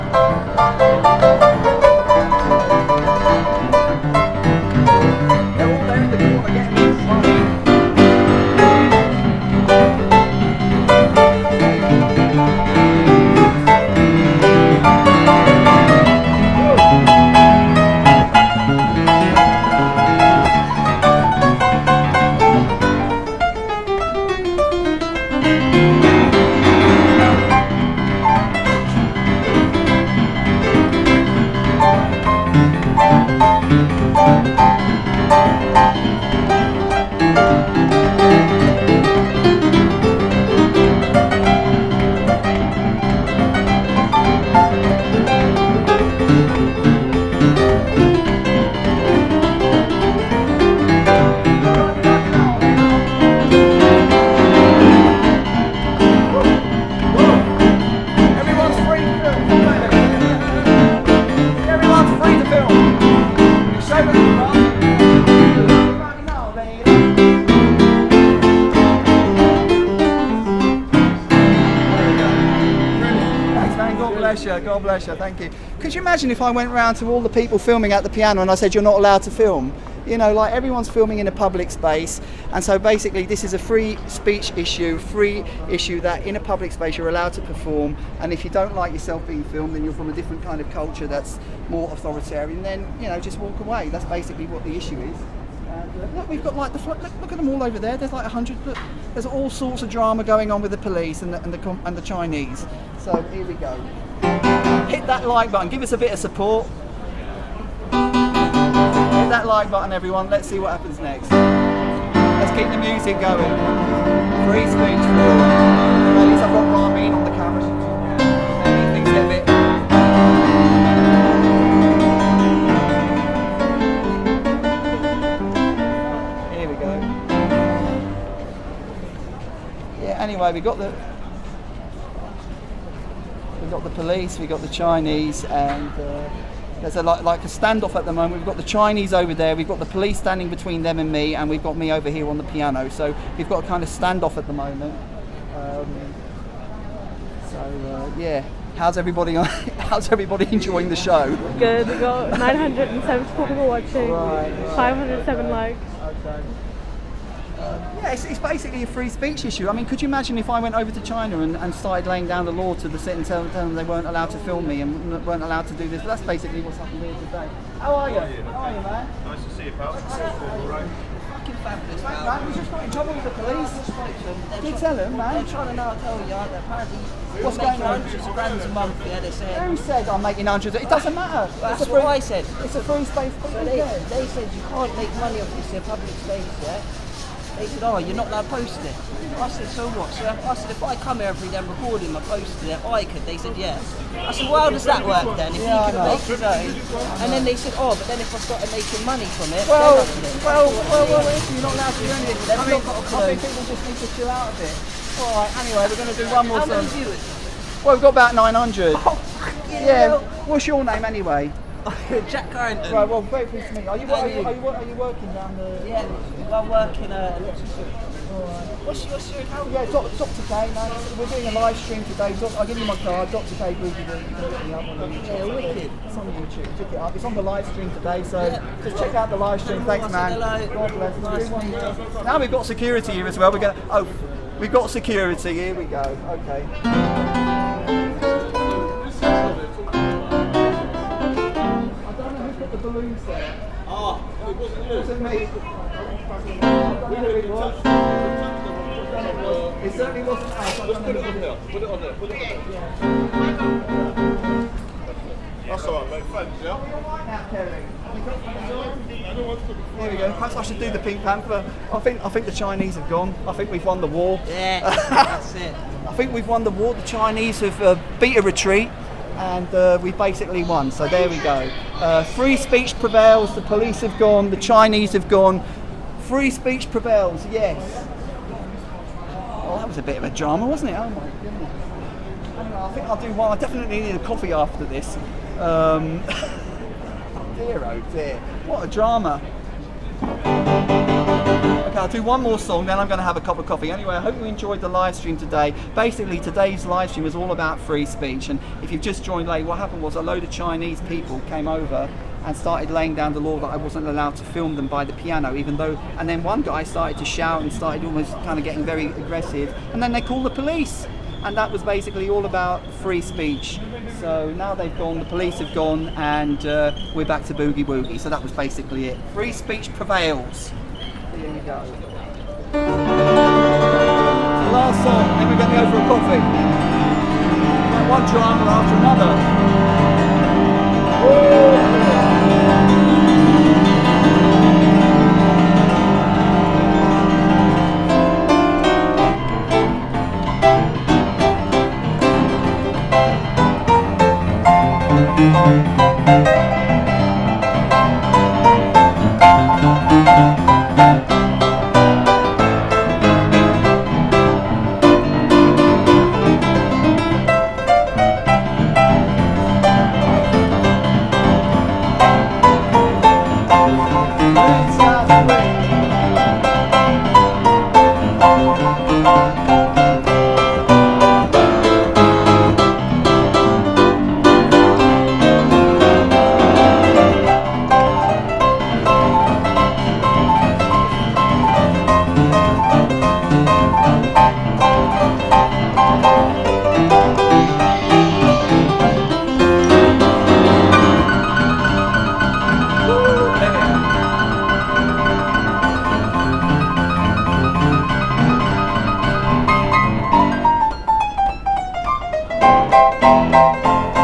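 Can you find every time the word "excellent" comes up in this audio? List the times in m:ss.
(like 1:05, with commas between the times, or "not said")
not said.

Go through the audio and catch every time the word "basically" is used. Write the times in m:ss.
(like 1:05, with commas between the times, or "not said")
1:22, 1:34, 2:38, 2:46, 4:30, 4:55, 5:11, 5:18.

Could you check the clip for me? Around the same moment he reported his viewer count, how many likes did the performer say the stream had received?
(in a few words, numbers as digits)
507.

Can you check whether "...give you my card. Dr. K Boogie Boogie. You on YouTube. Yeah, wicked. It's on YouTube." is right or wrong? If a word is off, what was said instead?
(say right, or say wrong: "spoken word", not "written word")
right.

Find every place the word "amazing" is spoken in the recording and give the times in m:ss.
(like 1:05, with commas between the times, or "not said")
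not said.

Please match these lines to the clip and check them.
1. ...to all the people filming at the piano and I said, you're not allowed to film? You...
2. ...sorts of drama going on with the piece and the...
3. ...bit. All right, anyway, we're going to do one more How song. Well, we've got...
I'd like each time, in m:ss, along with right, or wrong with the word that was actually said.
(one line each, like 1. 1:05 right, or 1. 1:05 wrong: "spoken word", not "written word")
1. 1:16 right
2. 1:39 wrong: "police", not "piece"
3. 3:24 right.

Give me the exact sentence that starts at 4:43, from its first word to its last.
I definitely need a coffee after this.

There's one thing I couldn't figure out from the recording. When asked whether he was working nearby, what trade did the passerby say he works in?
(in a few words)
Electrician.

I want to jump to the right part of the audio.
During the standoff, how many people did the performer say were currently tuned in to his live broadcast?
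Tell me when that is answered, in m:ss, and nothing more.
2:32.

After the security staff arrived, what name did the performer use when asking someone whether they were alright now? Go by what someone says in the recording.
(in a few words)
Kerry.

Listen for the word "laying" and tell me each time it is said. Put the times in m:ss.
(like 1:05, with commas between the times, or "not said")
2:42, 5:02.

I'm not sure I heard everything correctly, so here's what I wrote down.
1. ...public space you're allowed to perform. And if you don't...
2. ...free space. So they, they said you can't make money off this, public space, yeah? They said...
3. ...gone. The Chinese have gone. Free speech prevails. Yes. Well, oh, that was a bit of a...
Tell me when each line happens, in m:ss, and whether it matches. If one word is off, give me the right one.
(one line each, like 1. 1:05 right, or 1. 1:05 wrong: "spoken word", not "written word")
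1. 1:26 right
2. 3:02 right
3. 4:34 right.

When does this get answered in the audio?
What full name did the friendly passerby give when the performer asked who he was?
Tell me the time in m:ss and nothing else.
3:32.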